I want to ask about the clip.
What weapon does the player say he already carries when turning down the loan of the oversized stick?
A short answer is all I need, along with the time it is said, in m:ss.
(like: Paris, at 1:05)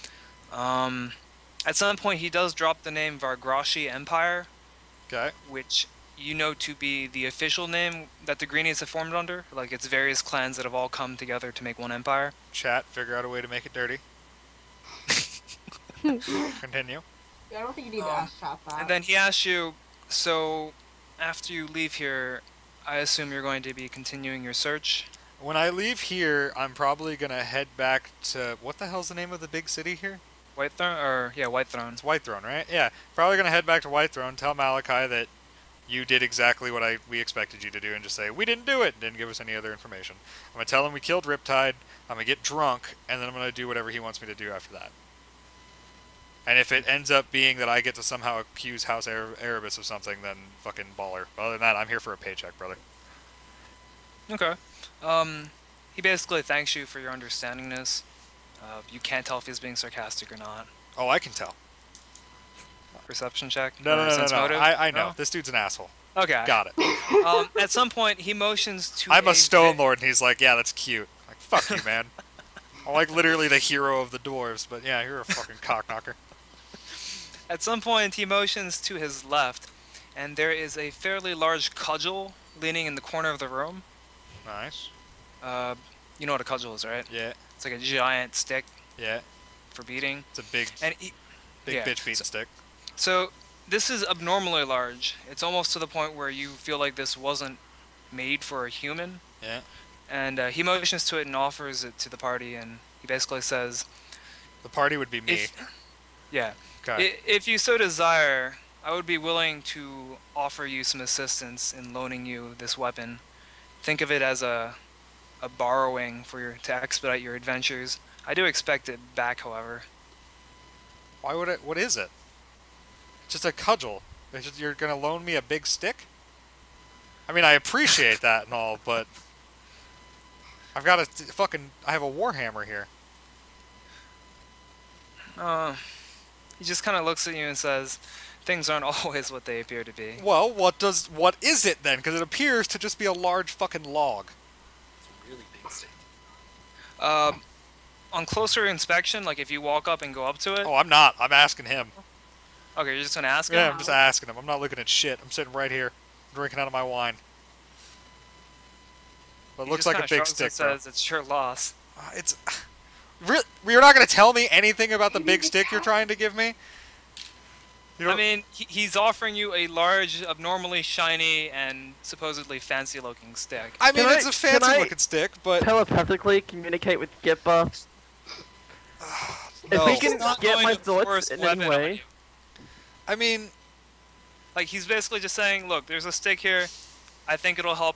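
warhammer, at 2:12.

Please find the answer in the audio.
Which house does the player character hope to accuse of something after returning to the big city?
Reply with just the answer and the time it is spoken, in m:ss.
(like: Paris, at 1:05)
House Erebus, at 0:48.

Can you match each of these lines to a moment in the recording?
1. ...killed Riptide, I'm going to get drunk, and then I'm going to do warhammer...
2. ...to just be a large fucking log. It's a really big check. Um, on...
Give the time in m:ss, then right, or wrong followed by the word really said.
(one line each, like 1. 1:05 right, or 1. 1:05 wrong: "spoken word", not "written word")
1. 0:41 wrong: "whatever", not "warhammer"
2. 2:22 wrong: "stick", not "check".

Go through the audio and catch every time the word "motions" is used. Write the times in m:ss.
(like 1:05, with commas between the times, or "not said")
1:08, 1:18, 1:40.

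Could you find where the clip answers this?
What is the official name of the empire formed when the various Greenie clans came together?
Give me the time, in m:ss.
0:03.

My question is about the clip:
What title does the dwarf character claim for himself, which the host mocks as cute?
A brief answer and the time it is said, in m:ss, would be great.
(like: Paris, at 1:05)
stone lord, at 1:09.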